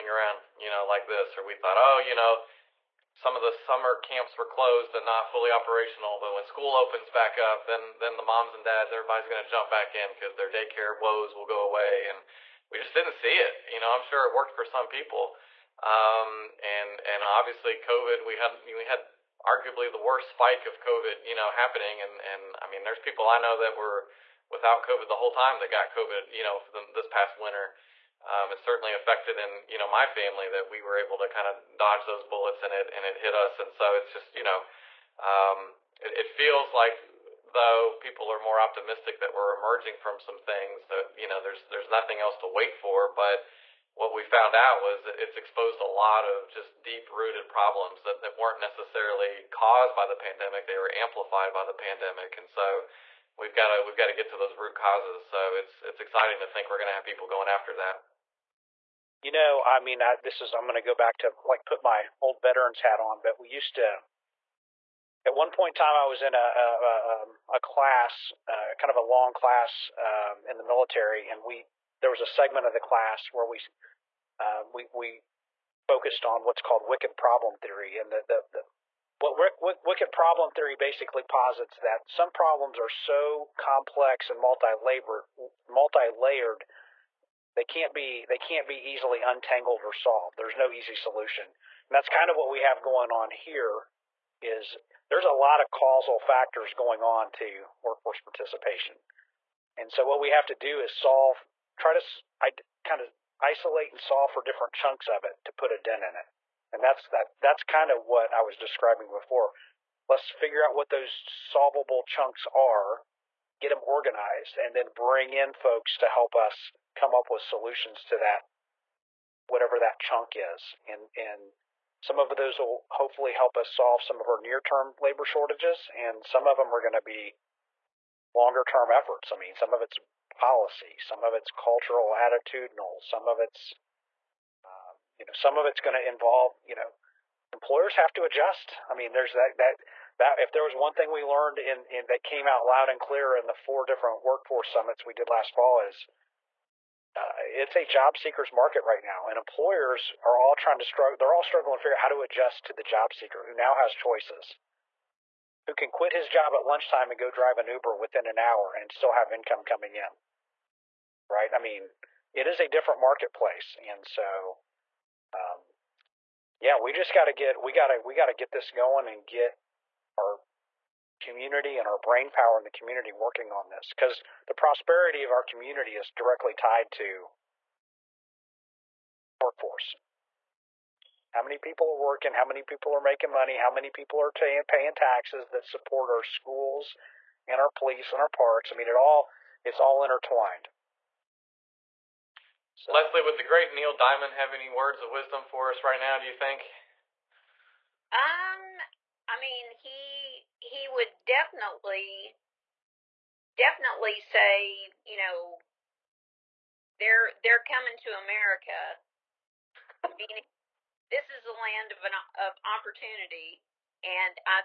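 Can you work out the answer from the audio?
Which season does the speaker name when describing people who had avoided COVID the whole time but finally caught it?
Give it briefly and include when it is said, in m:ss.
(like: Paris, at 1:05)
winter, at 0:27.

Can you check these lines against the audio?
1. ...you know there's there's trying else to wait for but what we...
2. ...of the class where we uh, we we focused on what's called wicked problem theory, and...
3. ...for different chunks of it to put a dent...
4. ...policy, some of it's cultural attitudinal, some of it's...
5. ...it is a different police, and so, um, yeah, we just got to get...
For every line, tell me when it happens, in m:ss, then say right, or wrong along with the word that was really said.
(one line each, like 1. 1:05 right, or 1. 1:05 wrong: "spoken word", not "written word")
1. 0:41 wrong: "nothing", not "trying"
2. 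1:12 right
3. 1:44 right
4. 2:10 right
5. 2:42 wrong: "marketplace", not "police".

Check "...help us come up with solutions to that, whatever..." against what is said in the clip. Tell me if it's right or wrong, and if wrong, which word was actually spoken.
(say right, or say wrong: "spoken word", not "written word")
right.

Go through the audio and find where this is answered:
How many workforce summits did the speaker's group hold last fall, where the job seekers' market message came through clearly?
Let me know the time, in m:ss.
2:23.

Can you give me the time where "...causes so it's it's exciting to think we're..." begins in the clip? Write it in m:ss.
0:54.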